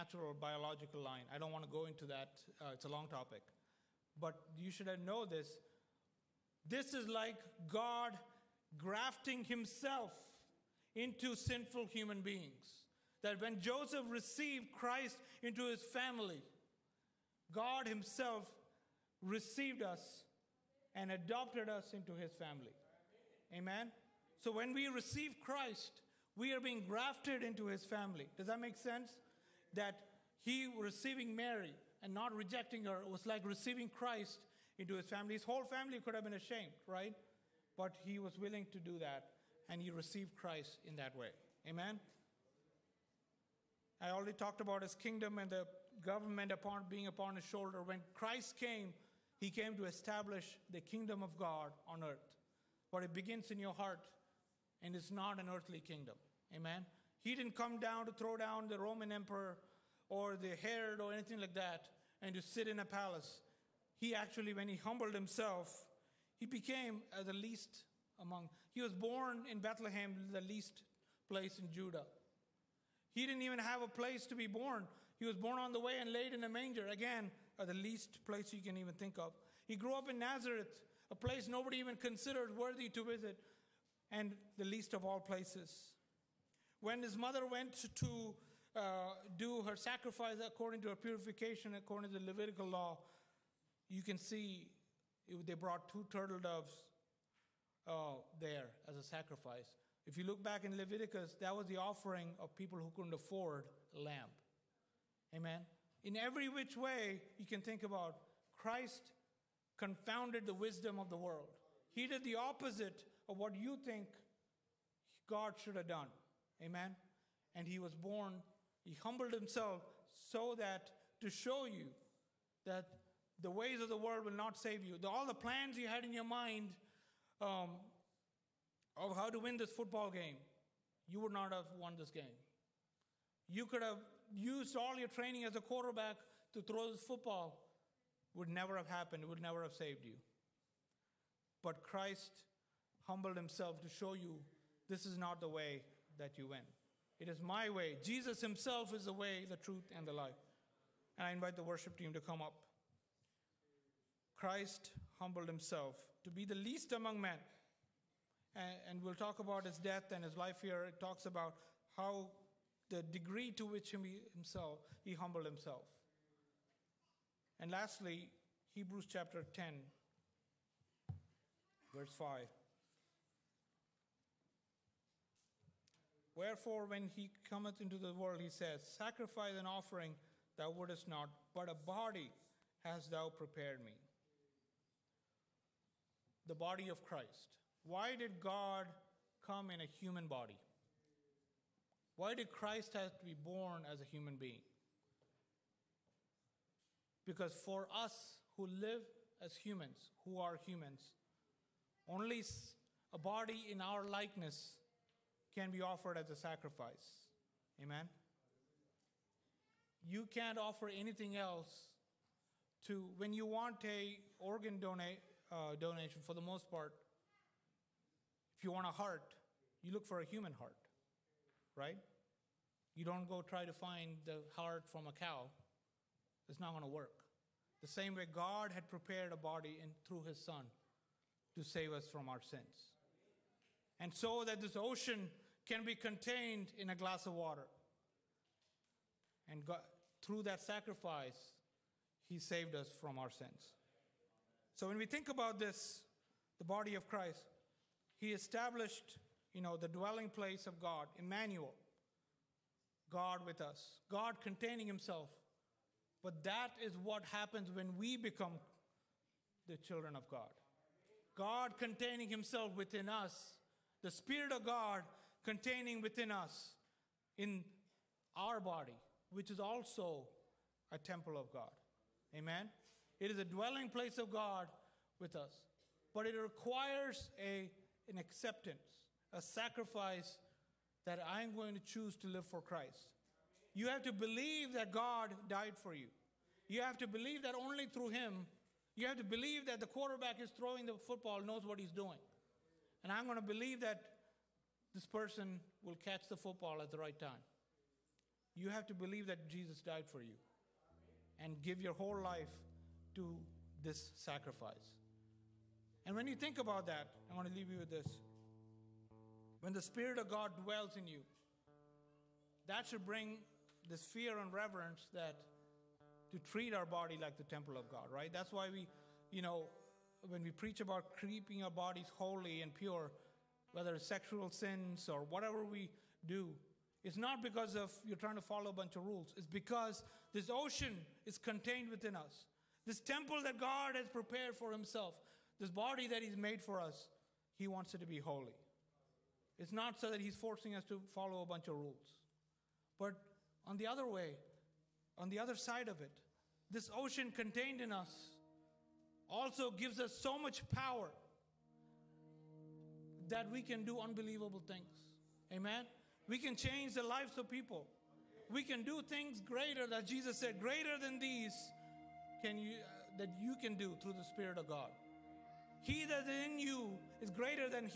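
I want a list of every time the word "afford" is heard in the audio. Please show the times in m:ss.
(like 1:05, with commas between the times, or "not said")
1:43.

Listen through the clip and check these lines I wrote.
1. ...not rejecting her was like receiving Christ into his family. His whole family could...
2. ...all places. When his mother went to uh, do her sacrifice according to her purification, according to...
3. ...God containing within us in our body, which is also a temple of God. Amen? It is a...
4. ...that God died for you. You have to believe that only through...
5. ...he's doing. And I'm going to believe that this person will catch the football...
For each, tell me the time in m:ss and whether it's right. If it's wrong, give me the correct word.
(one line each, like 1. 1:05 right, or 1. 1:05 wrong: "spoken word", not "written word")
1. 0:32 right
2. 1:25 right
3. 4:24 right
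4. 4:44 right
5. 4:51 right.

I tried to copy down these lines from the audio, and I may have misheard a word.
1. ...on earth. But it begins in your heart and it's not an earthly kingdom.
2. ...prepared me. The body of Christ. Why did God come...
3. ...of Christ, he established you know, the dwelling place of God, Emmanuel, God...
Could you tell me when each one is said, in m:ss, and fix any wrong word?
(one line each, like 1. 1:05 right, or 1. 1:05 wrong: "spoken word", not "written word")
1. 0:51 right
2. 3:03 right
3. 4:06 right.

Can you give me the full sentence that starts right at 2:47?
And lastly, Hebrews chapter 10 verse 5.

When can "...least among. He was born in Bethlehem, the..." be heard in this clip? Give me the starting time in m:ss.
1:07.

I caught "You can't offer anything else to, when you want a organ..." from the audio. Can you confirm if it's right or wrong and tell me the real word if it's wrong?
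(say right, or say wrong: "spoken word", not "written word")
right.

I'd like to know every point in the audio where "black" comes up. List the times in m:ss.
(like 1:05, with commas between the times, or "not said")
not said.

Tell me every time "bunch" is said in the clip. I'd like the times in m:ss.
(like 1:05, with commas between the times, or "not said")
5:28, 5:41.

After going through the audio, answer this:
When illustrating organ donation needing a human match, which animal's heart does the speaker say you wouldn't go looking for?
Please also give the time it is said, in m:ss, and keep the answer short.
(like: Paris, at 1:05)
a cow, at 3:45.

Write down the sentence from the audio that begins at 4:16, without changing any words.
But that is what happens when we become the children of God.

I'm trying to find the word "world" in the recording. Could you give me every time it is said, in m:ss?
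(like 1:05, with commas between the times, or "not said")
1:51, 2:03, 2:58.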